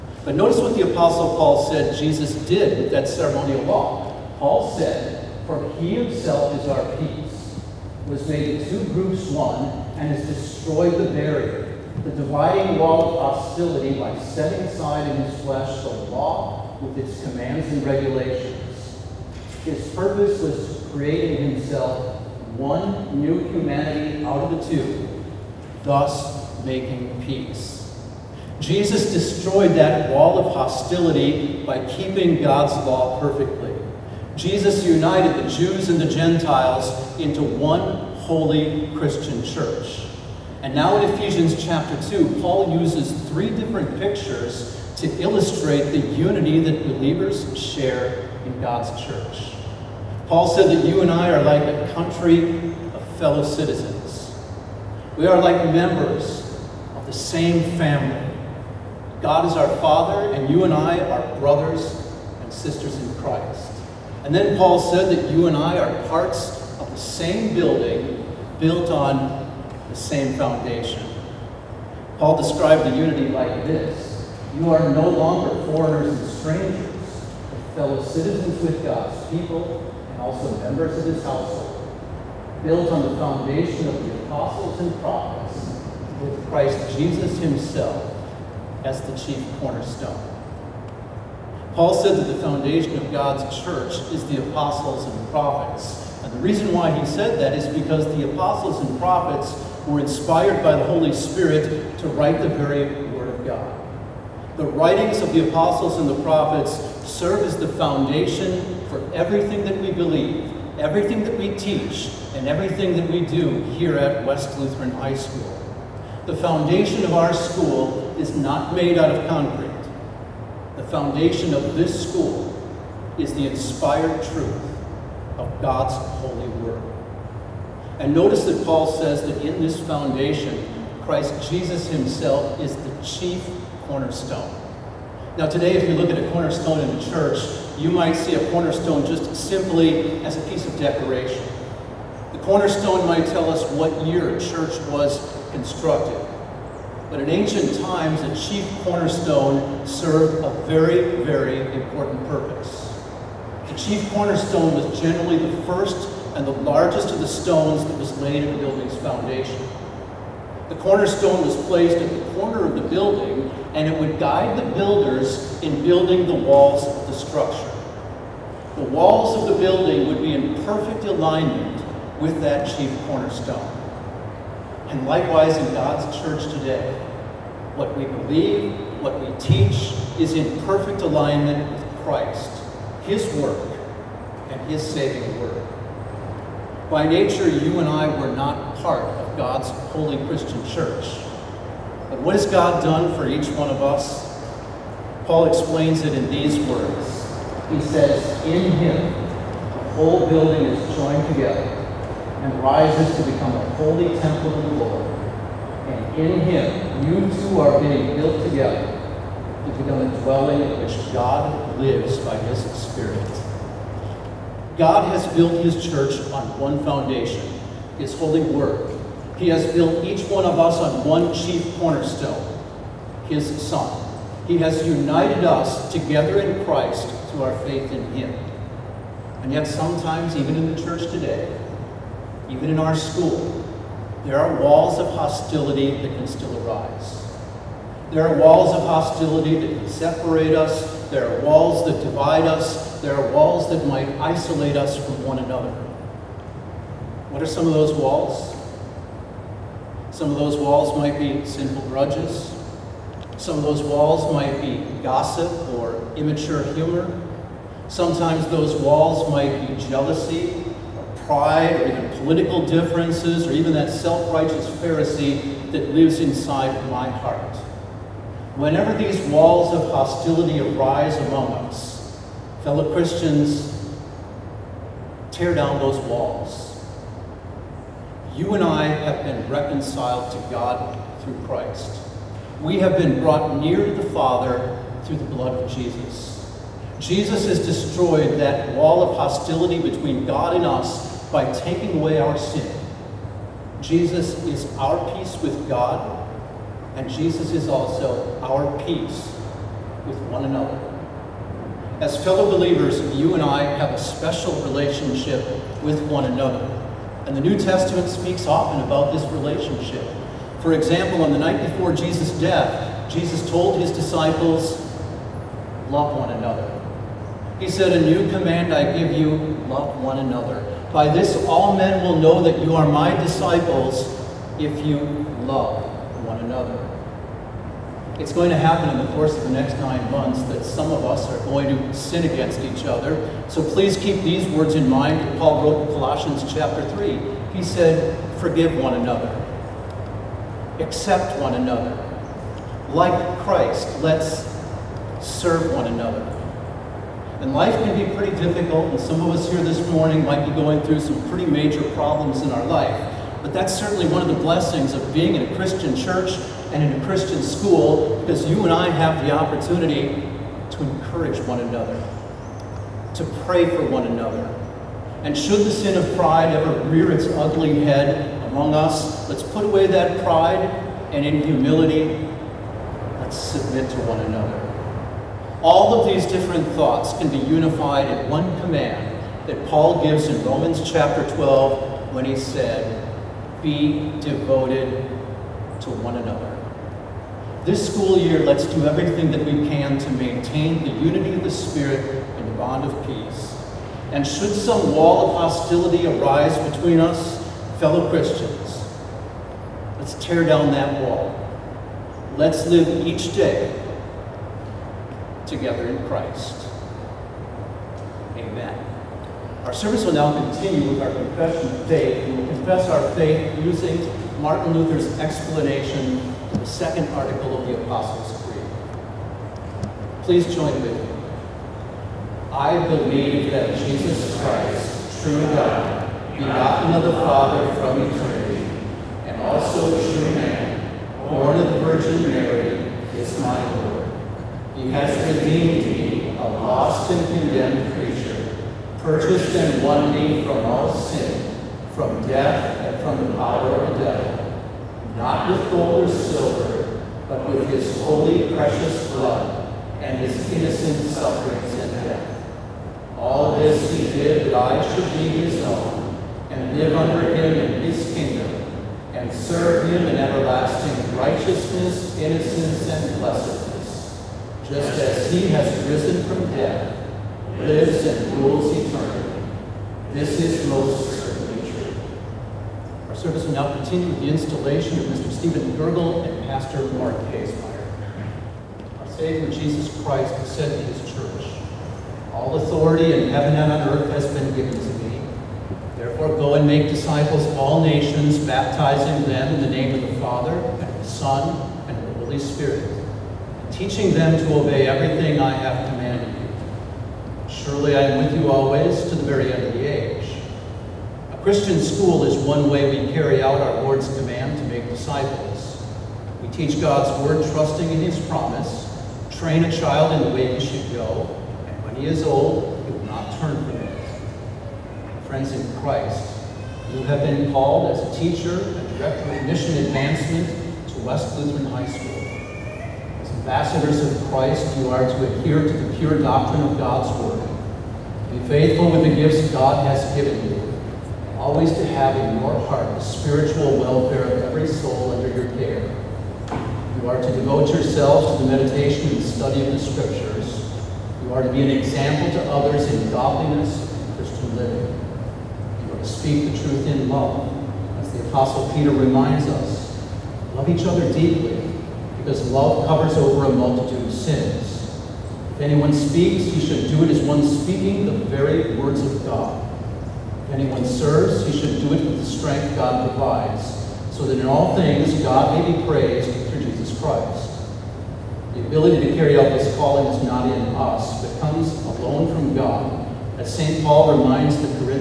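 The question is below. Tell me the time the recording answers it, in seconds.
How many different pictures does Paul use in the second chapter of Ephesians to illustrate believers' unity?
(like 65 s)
43 s.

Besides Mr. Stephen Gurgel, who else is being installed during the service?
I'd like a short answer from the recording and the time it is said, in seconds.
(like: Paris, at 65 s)
Pastor Mark Kaesmeyer, at 476 s.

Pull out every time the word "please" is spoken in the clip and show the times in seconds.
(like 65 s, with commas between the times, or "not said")
333 s, 420 s.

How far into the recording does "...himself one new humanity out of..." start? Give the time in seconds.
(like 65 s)
21 s.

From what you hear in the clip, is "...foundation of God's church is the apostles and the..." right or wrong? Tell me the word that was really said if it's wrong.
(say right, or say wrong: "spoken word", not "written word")
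right.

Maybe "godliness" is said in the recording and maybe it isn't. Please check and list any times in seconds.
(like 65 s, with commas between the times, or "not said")
543 s.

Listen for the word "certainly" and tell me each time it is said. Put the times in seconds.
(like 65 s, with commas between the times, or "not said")
353 s, 471 s.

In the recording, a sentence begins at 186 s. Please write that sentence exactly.
By nature, you and I were not part of God's holy Christian church.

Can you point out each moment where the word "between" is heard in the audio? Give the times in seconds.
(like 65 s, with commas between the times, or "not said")
289 s, 396 s.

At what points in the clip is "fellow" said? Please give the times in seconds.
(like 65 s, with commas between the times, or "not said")
53 s, 77 s, 272 s, 302 s, 397 s.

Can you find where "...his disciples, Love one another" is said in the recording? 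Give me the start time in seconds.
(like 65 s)
313 s.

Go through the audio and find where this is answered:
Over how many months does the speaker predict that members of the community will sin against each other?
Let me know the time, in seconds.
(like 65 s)
329 s.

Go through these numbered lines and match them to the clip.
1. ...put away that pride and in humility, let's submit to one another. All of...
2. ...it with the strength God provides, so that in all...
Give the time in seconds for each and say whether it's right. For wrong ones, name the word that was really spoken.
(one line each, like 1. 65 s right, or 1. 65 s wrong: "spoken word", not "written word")
1. 369 s right
2. 561 s right.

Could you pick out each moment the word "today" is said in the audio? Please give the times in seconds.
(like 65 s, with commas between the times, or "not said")
135 s, 176 s, 231 s.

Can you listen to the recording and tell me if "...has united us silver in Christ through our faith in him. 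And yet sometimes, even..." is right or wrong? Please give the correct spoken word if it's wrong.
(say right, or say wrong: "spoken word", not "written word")
wrong: "together", not "silver".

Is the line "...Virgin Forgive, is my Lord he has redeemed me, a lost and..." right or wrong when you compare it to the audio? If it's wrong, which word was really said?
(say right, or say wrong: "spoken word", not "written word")
wrong: "Mary", not "Forgive".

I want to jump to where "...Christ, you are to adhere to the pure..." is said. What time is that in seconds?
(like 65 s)
524 s.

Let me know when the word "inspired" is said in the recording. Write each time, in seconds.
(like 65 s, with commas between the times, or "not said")
99 s, 123 s.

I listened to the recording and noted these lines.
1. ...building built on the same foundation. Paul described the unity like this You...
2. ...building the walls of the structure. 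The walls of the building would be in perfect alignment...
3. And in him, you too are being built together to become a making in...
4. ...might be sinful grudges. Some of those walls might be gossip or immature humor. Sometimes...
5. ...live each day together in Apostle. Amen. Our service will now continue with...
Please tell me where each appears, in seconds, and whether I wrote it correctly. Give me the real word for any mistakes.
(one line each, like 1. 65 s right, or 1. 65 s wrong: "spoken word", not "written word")
1. 67 s right
2. 165 s right
3. 205 s wrong: "dwelling", not "making"
4. 250 s right
5. 402 s wrong: "Christ", not "Apostle".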